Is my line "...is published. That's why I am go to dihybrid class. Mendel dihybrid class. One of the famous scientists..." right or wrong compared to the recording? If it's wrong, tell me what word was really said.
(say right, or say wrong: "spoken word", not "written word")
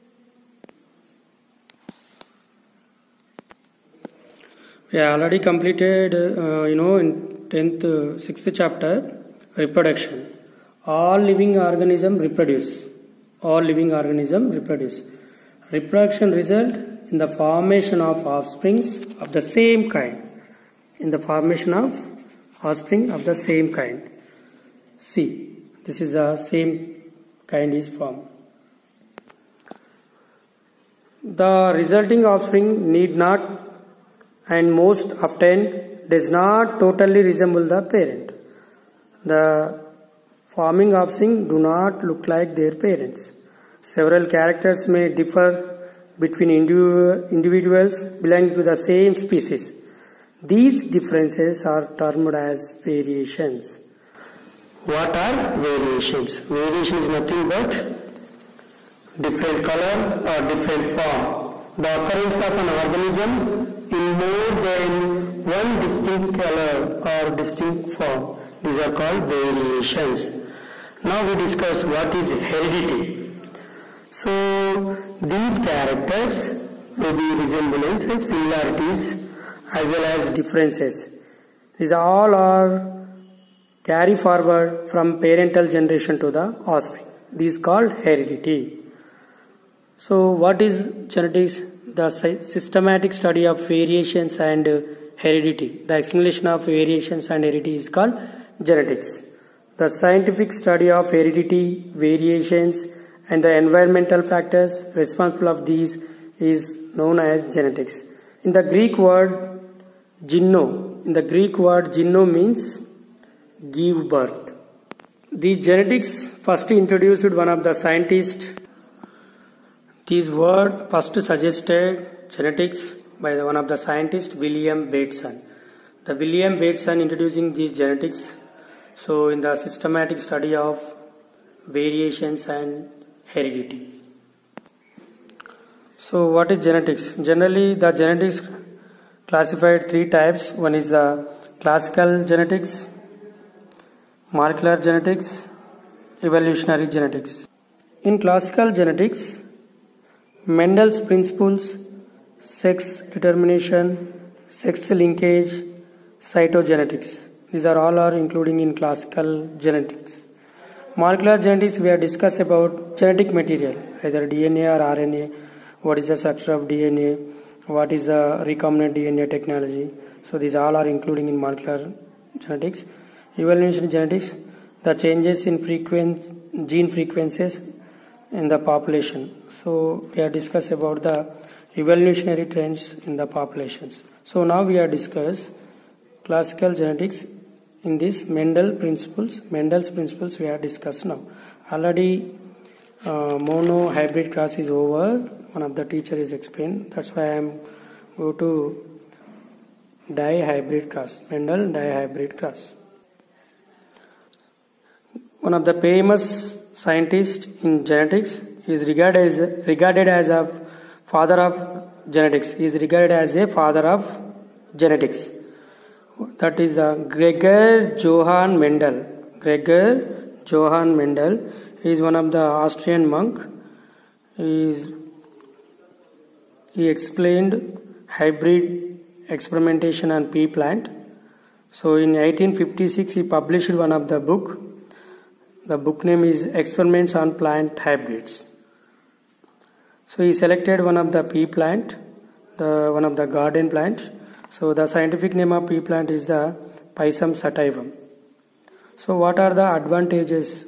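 wrong: "explained", not "published".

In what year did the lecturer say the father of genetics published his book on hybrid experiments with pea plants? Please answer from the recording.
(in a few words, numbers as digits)
1856.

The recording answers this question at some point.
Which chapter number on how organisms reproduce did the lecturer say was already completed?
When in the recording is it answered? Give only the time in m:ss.
0:08.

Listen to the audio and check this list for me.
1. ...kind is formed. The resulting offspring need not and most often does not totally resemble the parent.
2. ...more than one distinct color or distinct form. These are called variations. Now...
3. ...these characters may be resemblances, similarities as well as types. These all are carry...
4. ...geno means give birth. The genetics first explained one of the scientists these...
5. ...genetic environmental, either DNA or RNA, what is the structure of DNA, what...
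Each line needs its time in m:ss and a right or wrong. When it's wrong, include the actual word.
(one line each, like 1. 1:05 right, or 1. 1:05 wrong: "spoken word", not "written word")
1. 0:27 right
2. 1:04 right
3. 1:15 wrong: "differences", not "types"
4. 1:51 wrong: "introduced", not "explained"
5. 2:42 wrong: "material", not "environmental".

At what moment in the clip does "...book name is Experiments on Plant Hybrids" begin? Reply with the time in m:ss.
3:55.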